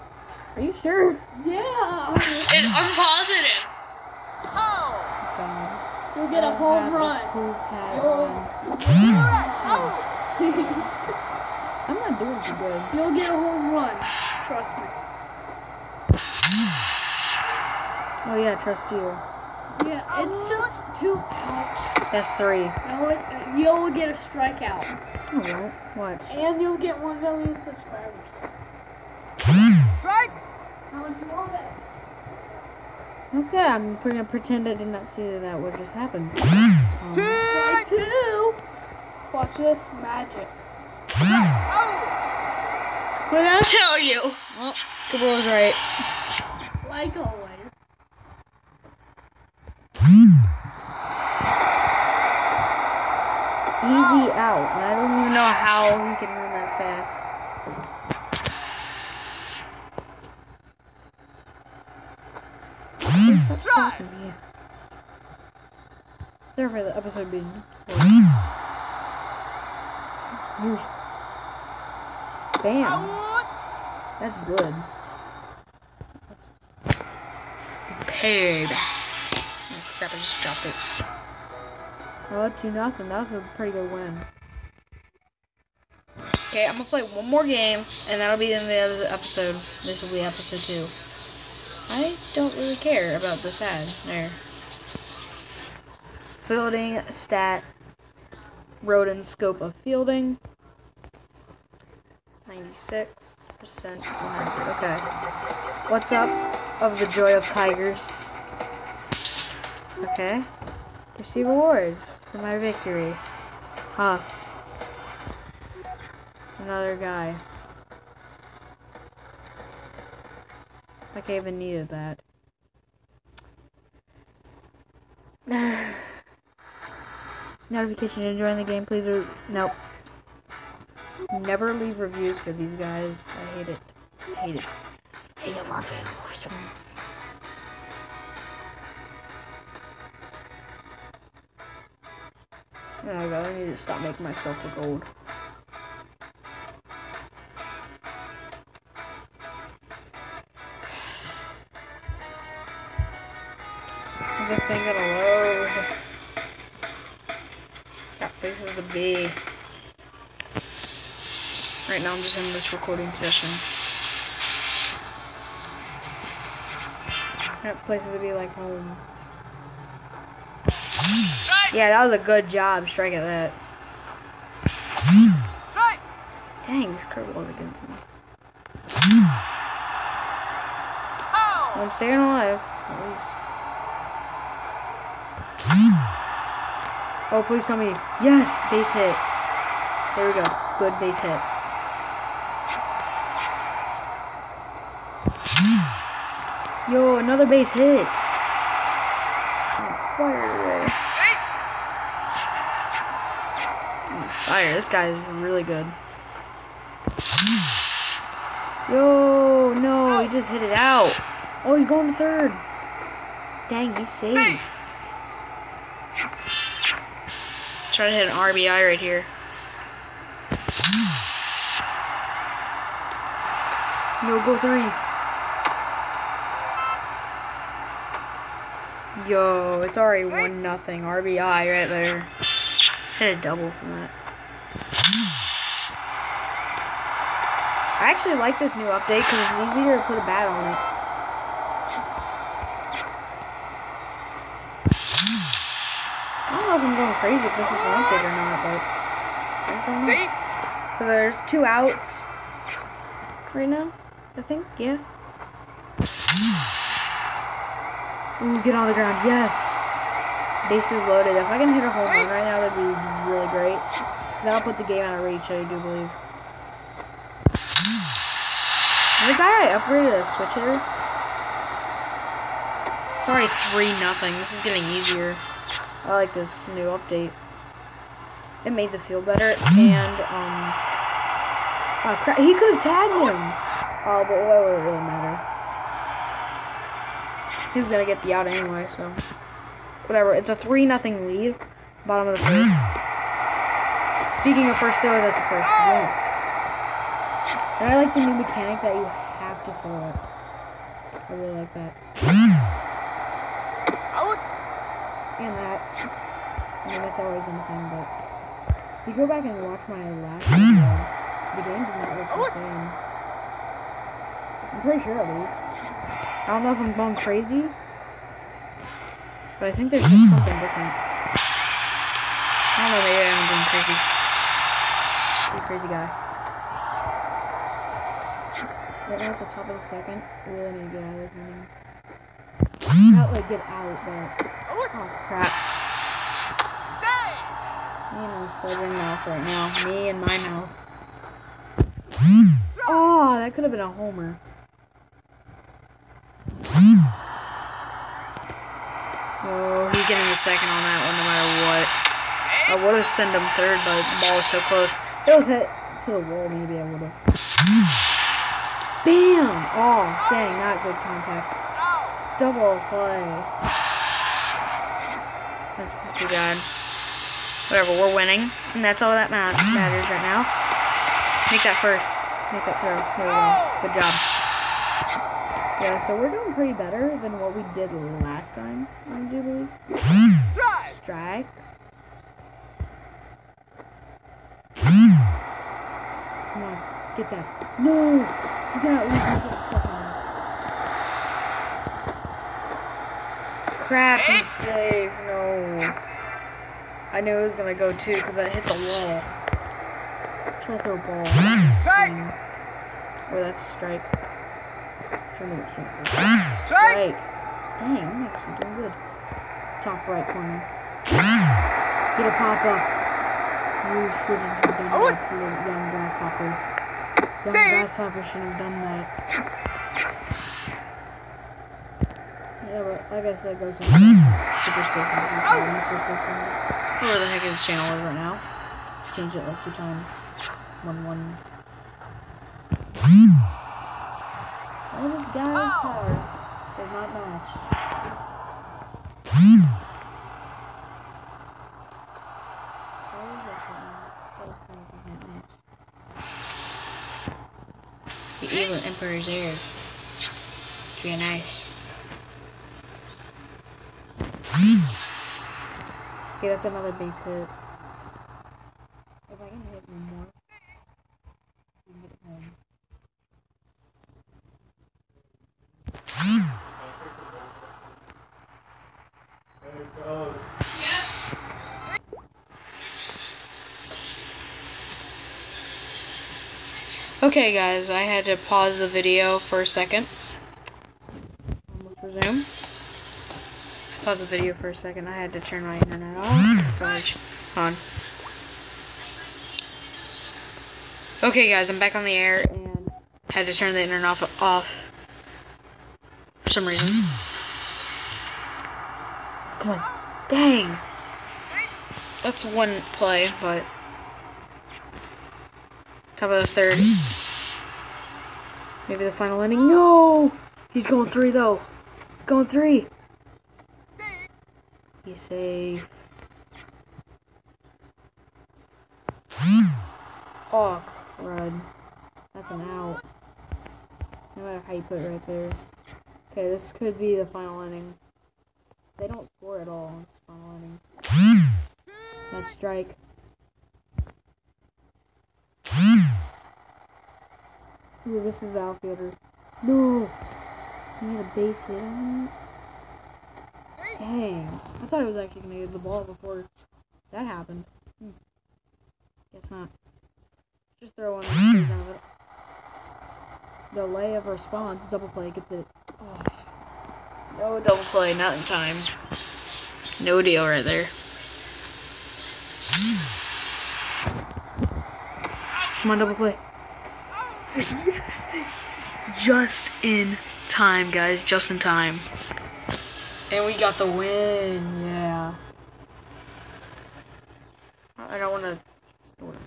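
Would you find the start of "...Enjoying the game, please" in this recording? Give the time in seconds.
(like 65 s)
128 s.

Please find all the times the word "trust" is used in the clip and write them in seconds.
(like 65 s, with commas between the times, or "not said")
14 s, 18 s.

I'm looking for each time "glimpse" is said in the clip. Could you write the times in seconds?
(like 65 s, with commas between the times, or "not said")
not said.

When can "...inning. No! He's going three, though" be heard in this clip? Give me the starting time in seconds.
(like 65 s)
509 s.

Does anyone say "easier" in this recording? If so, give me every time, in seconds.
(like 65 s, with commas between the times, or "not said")
239 s, 274 s.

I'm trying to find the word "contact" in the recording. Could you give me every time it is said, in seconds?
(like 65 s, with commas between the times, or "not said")
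360 s.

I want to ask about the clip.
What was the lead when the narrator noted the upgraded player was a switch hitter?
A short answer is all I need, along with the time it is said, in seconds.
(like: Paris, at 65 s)
3 nothing, at 273 s.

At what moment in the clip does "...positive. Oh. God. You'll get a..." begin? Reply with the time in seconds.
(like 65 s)
2 s.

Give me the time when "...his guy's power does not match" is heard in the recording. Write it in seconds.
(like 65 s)
435 s.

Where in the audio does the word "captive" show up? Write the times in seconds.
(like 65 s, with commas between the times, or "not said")
not said.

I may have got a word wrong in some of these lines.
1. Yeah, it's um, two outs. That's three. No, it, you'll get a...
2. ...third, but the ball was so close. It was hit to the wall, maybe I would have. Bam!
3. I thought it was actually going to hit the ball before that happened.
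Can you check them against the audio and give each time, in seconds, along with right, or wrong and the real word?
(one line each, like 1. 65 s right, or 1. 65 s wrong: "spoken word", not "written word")
1. 19 s right
2. 353 s right
3. 544 s right.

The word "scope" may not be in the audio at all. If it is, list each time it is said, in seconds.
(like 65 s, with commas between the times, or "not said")
99 s.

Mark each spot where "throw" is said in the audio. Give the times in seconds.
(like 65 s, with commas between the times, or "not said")
299 s, 372 s, 400 s, 550 s.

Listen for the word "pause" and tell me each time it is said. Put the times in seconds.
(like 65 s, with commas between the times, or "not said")
478 s, 484 s.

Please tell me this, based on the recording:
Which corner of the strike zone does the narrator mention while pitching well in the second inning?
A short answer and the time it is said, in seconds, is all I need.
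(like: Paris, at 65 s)
top right corner, at 409 s.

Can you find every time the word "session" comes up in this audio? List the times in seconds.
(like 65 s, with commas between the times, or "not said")
163 s.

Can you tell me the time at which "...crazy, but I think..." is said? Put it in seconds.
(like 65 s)
317 s.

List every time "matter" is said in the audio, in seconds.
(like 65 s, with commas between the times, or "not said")
284 s, 351 s, 369 s, 524 s.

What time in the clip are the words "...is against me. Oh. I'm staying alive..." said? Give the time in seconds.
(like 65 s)
177 s.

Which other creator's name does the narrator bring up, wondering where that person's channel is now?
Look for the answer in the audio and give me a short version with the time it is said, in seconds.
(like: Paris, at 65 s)
Super Space Monkey, at 423 s.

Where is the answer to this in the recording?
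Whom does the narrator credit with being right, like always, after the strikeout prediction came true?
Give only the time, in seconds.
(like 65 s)
45 s.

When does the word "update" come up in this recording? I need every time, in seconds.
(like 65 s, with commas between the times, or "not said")
238 s, 247 s, 276 s.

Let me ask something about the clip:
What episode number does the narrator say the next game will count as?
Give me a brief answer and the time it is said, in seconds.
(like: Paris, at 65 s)
episode two, at 90 s.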